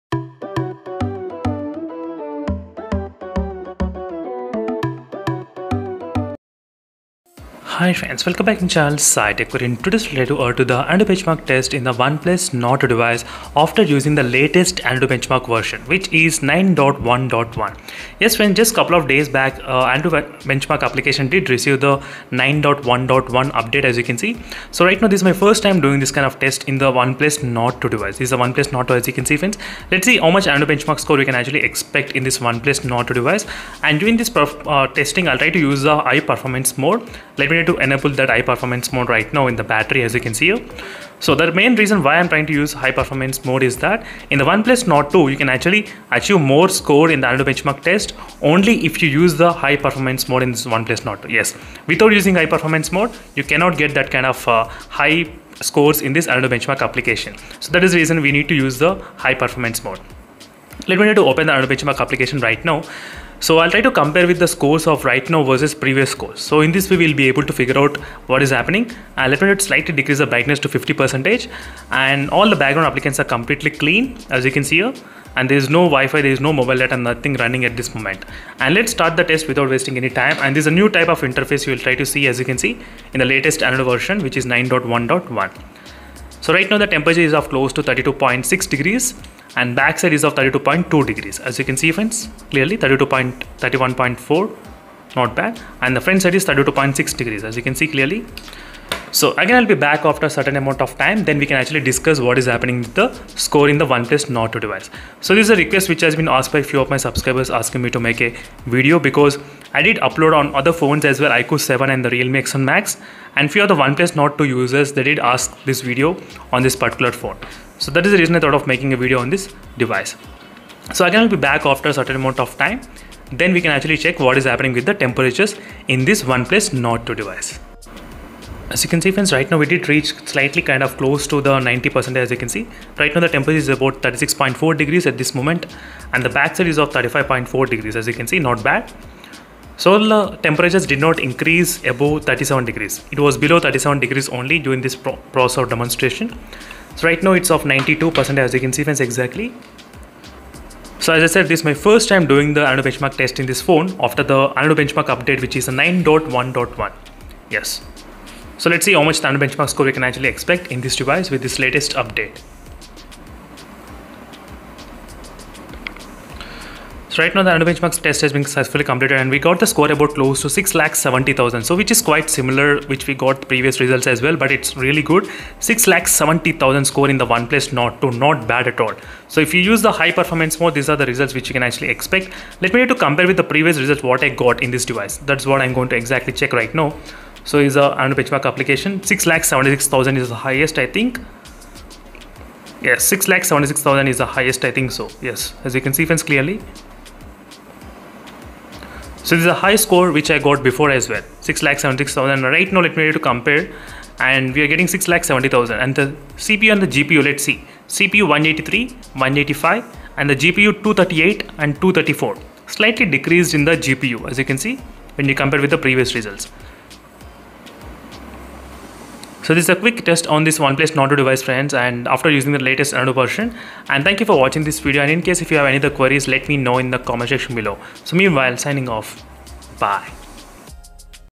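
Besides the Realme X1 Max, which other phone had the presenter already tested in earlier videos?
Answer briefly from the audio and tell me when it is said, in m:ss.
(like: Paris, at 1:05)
iQOO 7, at 1:51.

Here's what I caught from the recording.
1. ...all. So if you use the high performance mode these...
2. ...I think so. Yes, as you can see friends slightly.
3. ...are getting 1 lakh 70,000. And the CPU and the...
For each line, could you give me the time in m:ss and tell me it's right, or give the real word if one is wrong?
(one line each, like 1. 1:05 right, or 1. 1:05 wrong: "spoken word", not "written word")
1. 2:58 right
2. 3:14 wrong: "clearly", not "slightly"
3. 3:24 wrong: "6", not "1".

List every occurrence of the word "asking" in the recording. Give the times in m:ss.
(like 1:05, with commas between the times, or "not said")
1:47.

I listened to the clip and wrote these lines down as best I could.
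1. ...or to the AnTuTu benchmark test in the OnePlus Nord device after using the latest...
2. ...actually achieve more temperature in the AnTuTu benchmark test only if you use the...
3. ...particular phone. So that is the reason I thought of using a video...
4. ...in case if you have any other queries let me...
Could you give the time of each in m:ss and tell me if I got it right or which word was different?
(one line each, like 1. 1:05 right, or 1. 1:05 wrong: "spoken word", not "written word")
1. 0:10 right
2. 0:45 wrong: "score", not "temperature"
3. 1:56 wrong: "making", not "using"
4. 3:45 right.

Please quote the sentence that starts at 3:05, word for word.
That's what I'm going to exactly check right now.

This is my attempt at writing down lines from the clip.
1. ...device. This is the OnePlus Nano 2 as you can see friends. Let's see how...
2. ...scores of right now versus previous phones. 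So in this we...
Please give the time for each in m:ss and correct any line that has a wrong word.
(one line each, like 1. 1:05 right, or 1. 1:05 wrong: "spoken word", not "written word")
1. 0:27 wrong: "Nord", not "Nano"
2. 1:04 wrong: "scores", not "phones".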